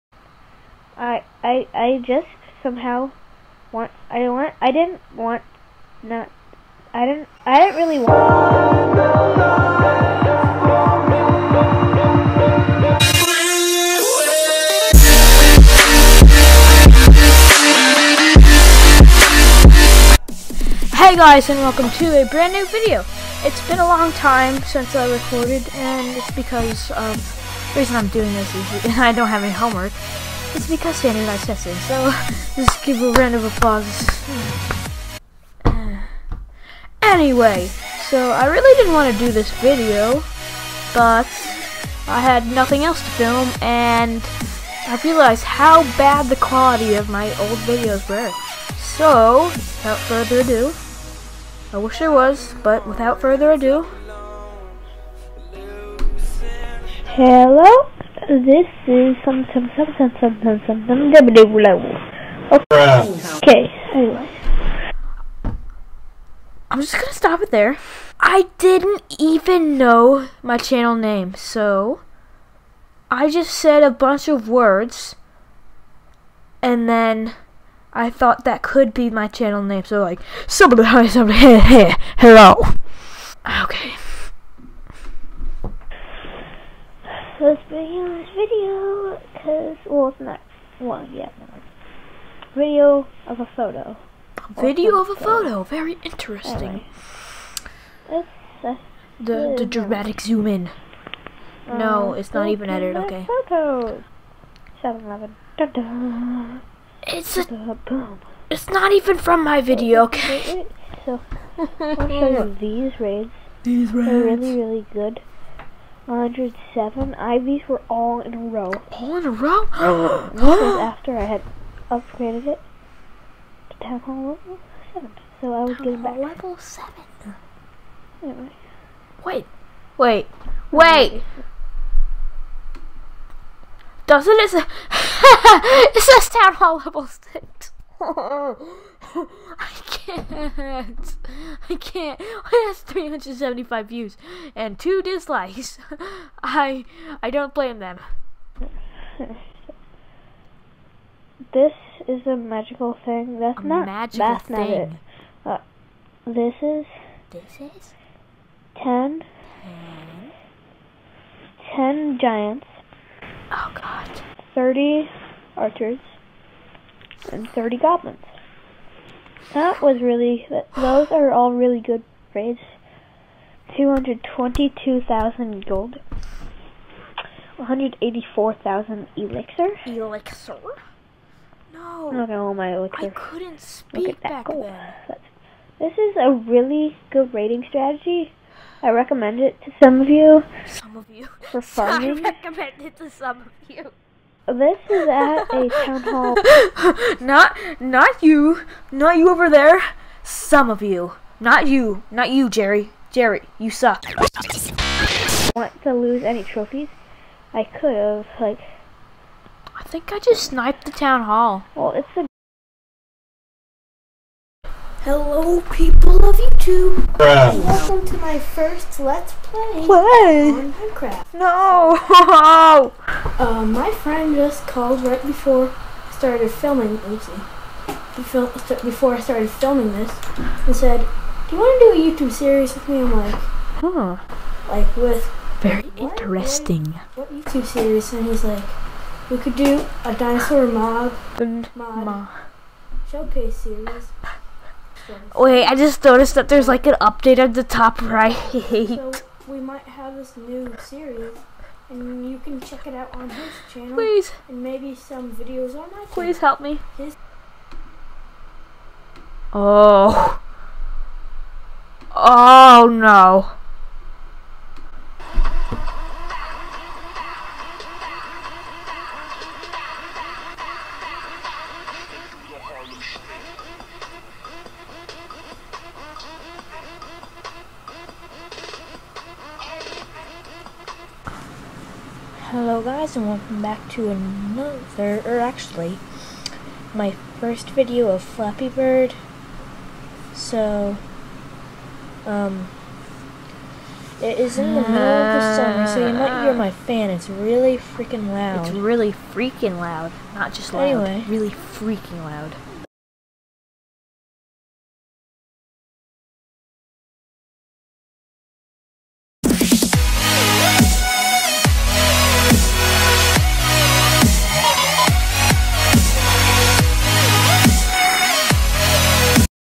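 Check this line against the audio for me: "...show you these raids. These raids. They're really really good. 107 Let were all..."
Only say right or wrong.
wrong.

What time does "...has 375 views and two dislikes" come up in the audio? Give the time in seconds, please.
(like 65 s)
142 s.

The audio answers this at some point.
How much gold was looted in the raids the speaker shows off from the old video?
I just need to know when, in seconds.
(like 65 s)
173 s.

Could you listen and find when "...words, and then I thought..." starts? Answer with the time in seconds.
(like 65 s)
74 s.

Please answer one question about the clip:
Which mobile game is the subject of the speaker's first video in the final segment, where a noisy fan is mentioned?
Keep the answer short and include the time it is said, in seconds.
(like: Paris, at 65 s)
Flappy Bird, at 288 s.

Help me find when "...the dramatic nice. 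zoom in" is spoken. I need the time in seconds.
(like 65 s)
99 s.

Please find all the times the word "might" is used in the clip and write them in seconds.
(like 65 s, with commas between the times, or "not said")
249 s, 296 s.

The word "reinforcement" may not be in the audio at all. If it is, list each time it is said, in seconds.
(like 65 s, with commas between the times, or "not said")
not said.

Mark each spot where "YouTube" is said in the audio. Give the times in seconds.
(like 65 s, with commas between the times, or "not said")
216 s, 232 s, 237 s.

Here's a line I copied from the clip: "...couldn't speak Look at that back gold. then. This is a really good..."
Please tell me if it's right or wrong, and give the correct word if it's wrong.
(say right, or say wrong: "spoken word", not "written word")
right.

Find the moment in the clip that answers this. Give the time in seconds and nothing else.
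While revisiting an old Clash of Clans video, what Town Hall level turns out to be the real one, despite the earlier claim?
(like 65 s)
136 s.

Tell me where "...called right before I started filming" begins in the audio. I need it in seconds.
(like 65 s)
224 s.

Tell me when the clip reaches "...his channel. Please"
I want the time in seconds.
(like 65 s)
253 s.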